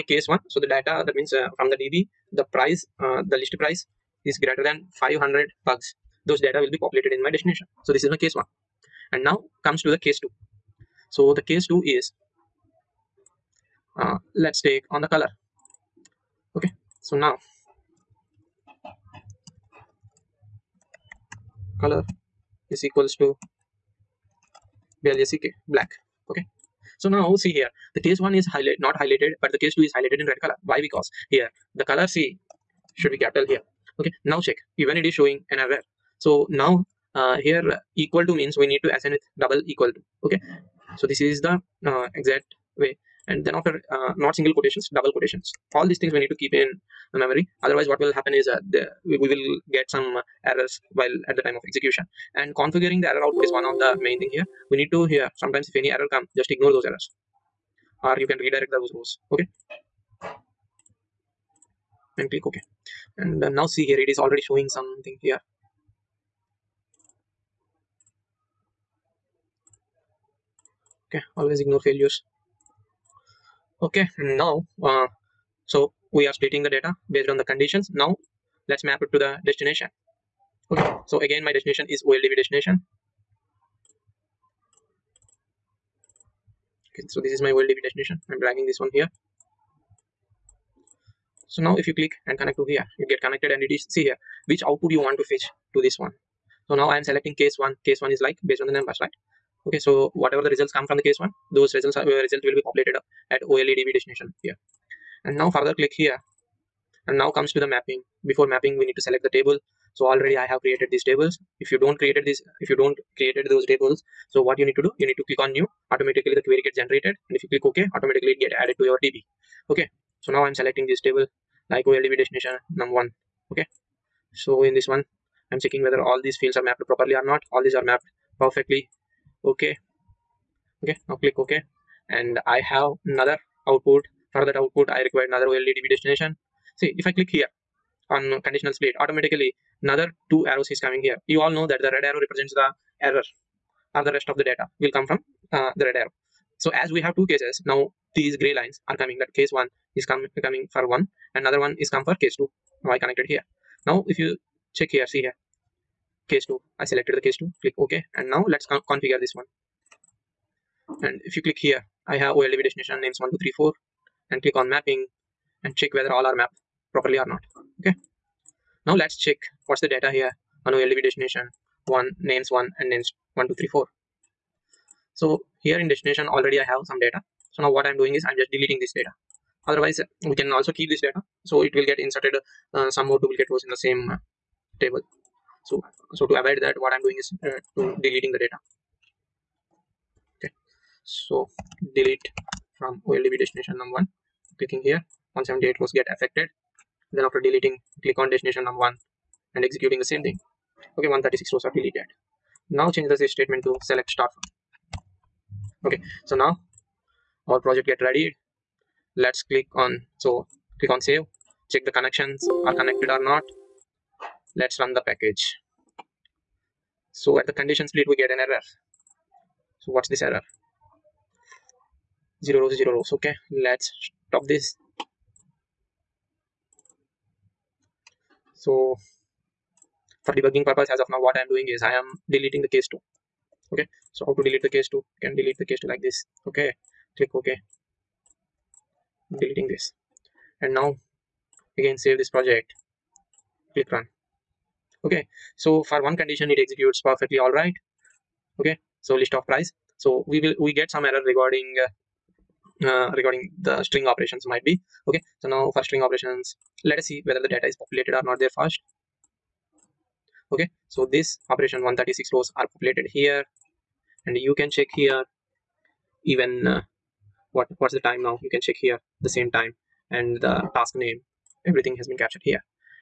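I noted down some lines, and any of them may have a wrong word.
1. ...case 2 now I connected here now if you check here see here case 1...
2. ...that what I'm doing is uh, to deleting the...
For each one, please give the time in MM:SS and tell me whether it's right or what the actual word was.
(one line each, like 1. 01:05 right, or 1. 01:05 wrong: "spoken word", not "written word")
1. 02:32 wrong: "2", not "1"
2. 03:06 right.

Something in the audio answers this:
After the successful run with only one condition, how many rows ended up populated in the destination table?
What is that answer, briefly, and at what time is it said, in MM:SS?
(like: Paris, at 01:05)
136, at 04:21.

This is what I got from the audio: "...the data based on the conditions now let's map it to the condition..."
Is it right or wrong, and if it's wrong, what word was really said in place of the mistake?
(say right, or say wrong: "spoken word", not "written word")
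wrong: "destination", not "condition".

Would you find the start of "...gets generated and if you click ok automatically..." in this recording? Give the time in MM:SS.
01:56.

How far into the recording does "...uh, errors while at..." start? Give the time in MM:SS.
00:50.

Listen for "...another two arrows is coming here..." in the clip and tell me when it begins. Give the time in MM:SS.
02:19.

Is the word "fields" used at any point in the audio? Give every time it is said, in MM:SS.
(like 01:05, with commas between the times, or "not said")
02:06.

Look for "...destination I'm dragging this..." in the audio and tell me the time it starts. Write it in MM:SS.
01:27.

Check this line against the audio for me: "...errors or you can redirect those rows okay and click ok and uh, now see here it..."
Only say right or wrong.
right.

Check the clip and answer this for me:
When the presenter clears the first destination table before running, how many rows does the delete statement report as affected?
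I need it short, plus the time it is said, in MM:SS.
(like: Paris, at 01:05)
178, at 03:15.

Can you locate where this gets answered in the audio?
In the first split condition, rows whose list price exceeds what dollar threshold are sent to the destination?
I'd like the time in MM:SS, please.
00:05.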